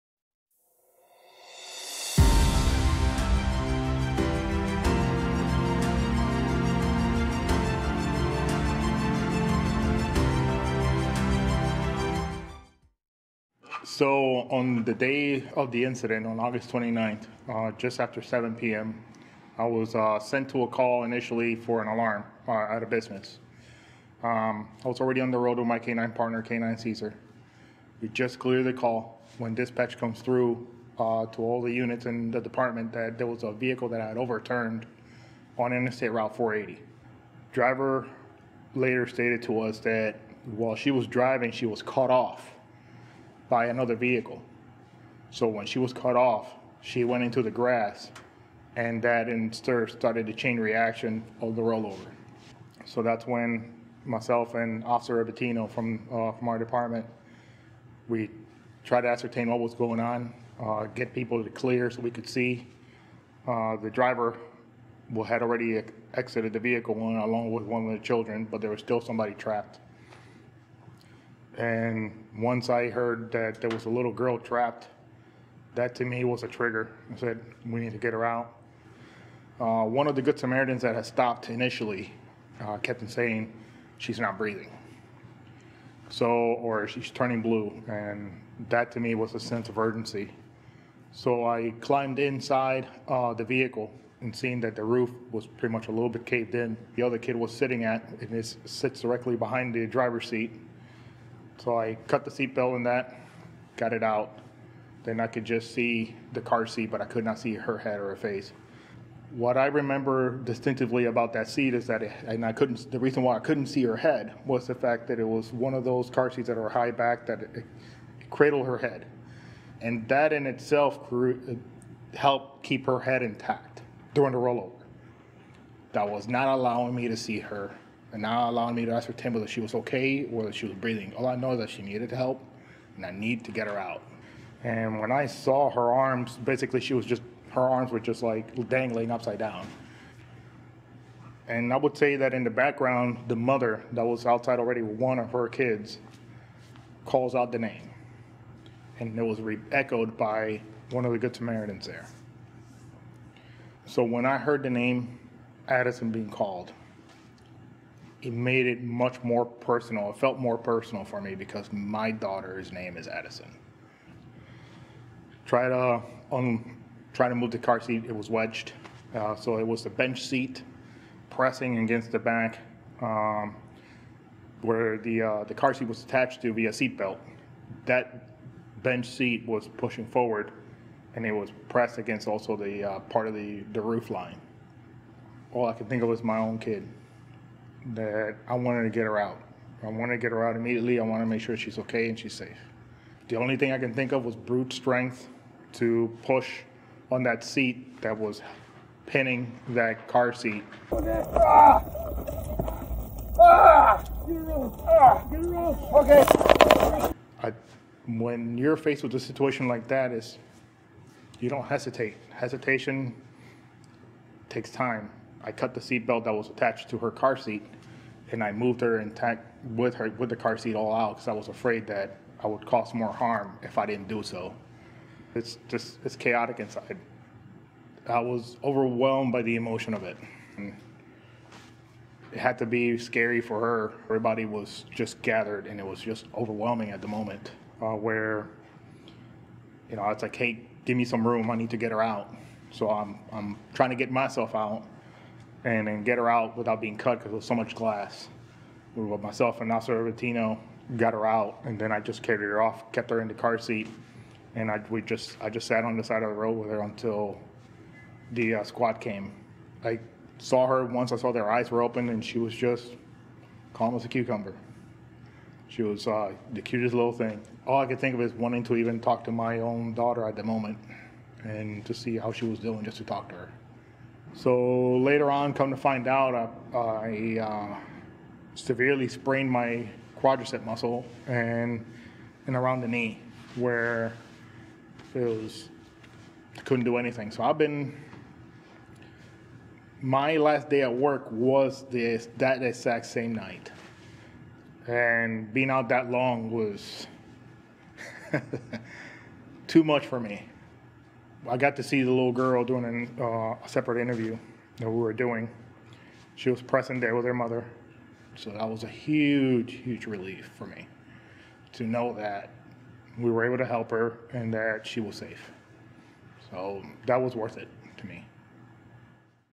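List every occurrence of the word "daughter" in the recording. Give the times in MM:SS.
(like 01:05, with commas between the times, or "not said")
02:42, 04:29.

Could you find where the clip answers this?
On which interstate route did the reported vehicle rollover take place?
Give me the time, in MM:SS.
00:36.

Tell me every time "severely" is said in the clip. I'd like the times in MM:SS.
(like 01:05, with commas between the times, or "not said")
04:38.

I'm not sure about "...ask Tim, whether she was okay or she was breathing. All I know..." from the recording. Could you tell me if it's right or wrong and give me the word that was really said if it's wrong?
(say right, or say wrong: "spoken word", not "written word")
right.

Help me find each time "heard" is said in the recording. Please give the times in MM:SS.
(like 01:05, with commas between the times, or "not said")
01:12, 02:34.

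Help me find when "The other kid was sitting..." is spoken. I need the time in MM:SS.
01:36.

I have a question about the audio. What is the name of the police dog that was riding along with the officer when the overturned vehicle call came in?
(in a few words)
Caesar.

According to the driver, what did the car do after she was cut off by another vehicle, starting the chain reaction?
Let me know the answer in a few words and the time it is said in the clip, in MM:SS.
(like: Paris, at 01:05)
Went into the grass, at 00:47.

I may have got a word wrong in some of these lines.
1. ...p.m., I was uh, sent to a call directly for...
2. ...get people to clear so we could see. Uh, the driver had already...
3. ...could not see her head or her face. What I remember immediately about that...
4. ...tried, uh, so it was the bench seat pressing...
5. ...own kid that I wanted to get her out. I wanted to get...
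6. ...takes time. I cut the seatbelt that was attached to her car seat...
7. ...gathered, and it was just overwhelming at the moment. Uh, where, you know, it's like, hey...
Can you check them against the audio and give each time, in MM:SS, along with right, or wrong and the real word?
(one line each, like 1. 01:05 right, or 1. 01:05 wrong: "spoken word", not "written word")
1. 00:18 wrong: "initially", not "directly"
2. 01:00 right
3. 01:47 wrong: "distinctively", not "immediately"
4. 02:48 wrong: "wedged", not "tried"
5. 03:06 right
6. 03:34 right
7. 03:55 right.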